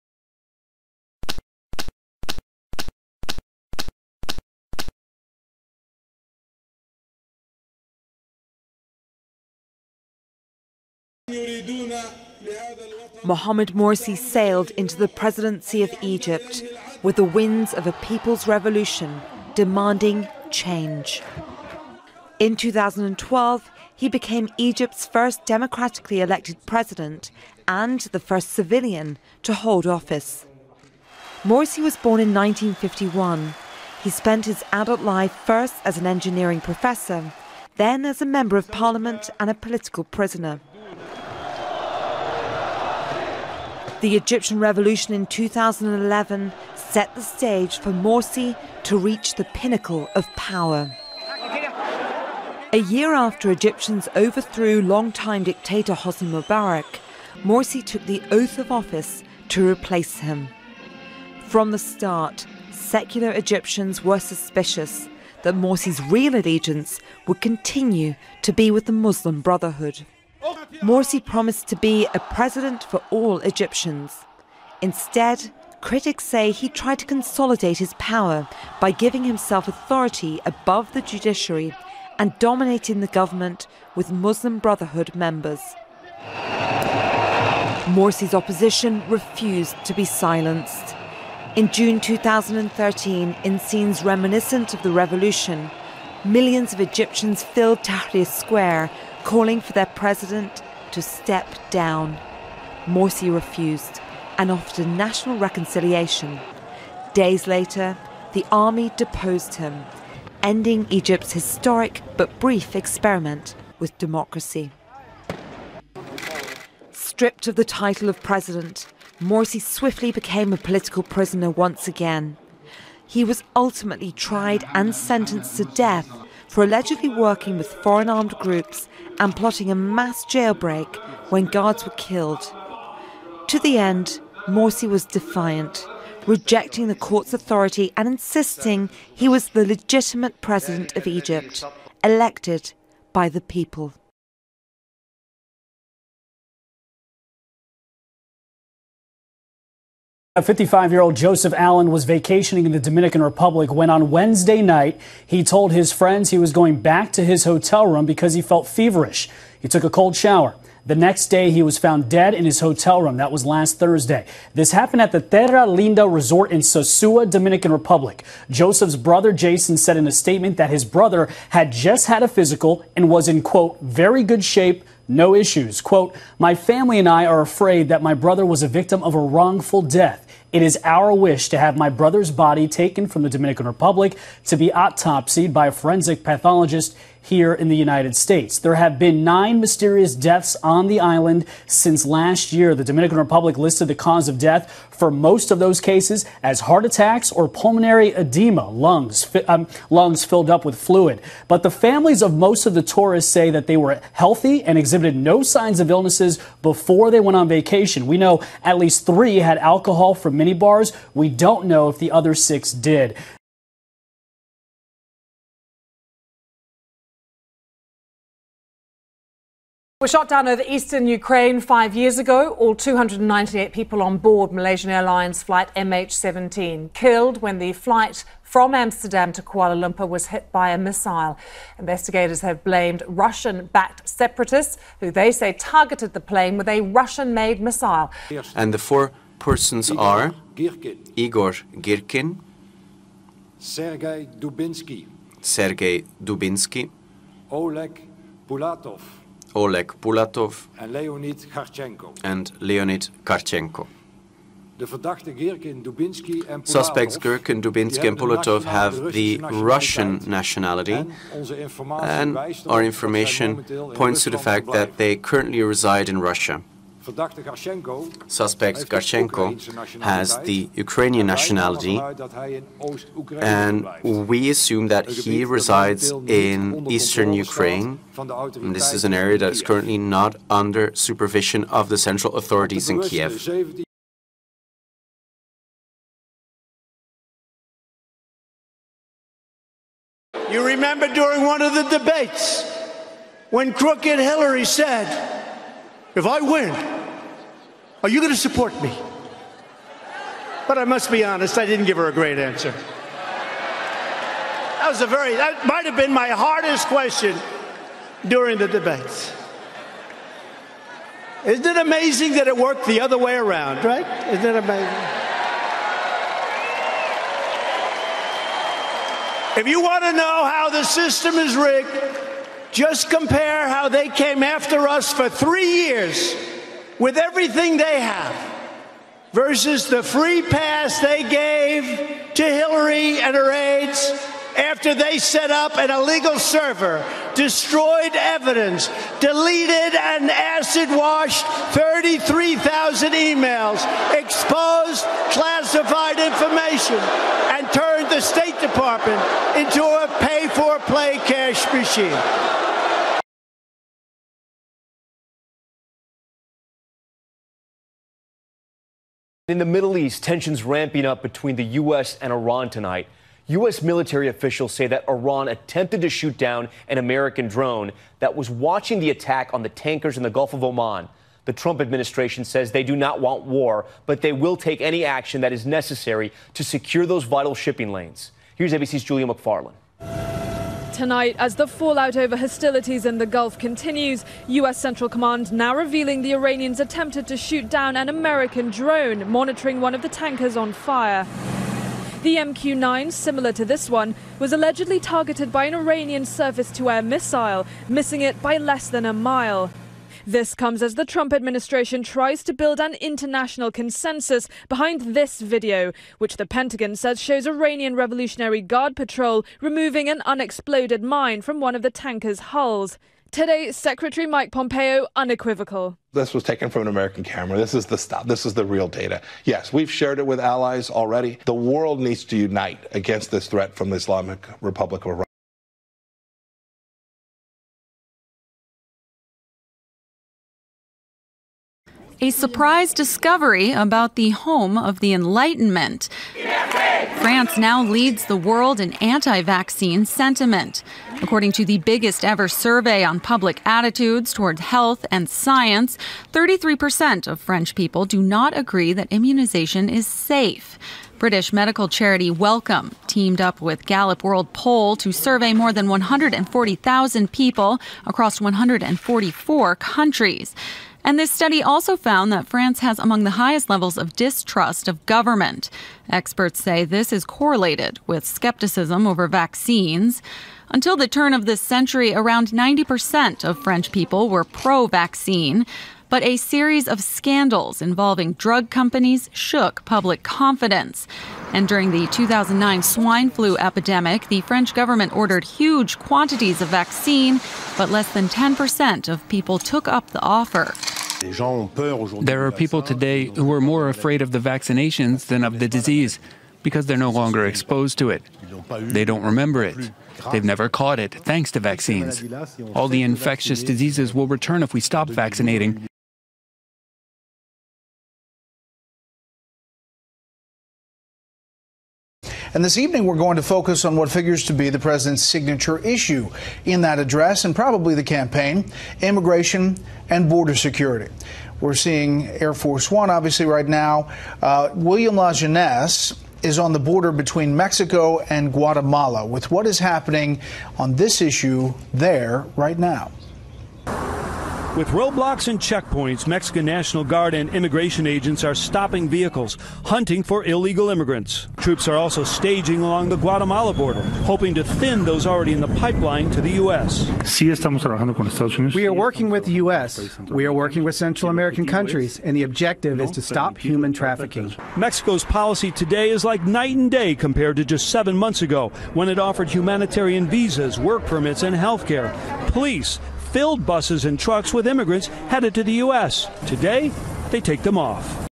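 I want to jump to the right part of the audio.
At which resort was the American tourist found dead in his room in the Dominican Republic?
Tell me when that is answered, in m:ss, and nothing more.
2:45.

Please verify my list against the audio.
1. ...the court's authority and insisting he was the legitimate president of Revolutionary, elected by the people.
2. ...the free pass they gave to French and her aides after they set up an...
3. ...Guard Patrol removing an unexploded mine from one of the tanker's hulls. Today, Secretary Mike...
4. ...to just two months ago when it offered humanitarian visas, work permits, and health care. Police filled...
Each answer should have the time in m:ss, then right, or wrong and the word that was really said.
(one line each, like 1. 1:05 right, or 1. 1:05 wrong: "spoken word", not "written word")
1. 2:16 wrong: "Egypt", not "Revolutionary"
2. 5:29 wrong: "Hillary", not "French"
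3. 6:48 right
4. 9:17 wrong: "seven", not "two".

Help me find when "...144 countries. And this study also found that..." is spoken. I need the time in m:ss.
7:38.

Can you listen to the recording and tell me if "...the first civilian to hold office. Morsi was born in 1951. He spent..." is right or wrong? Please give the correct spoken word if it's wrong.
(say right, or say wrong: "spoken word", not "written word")
right.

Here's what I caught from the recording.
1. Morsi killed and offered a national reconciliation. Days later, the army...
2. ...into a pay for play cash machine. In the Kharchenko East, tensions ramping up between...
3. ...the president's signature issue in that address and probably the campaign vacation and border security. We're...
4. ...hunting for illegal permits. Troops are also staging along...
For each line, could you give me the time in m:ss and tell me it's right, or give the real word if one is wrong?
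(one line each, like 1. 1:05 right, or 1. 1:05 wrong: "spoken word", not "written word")
1. 1:42 wrong: "refused", not "killed"
2. 5:49 wrong: "Middle", not "Kharchenko"
3. 8:34 wrong: "immigration", not "vacation"
4. 8:59 wrong: "immigrants", not "permits".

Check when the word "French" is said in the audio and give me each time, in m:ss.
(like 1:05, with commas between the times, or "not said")
7:27, 7:53, 8:04.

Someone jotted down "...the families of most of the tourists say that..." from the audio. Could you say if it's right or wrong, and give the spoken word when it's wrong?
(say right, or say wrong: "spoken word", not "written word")
right.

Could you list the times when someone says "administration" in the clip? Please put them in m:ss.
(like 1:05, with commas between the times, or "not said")
6:11, 6:41.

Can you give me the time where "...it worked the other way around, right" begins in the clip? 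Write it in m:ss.
5:12.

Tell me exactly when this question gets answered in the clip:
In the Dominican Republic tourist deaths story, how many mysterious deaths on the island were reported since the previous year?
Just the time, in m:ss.
3:09.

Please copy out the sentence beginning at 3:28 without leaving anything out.
We know at least three had alcohol from minibars.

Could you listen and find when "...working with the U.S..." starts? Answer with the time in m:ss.
9:08.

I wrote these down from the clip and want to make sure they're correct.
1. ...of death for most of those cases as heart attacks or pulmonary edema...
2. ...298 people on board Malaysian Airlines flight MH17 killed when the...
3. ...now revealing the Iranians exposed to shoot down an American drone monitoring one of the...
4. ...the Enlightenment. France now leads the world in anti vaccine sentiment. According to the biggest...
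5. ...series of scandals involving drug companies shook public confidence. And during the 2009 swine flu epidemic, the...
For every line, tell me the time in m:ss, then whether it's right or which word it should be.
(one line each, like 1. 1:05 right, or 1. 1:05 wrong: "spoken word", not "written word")
1. 3:14 right
2. 3:42 right
3. 6:25 wrong: "attempted", not "exposed"
4. 7:14 right
5. 7:56 right.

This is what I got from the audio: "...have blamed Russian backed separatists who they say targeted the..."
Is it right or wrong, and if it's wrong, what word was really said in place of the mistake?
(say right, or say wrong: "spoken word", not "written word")
right.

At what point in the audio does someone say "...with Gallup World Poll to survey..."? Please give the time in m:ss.
7:33.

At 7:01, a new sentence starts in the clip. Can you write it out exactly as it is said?
The world needs to unite against this threat from the Islamic Republic of Iran.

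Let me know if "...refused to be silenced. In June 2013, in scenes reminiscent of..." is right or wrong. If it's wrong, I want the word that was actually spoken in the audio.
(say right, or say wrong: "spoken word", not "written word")
right.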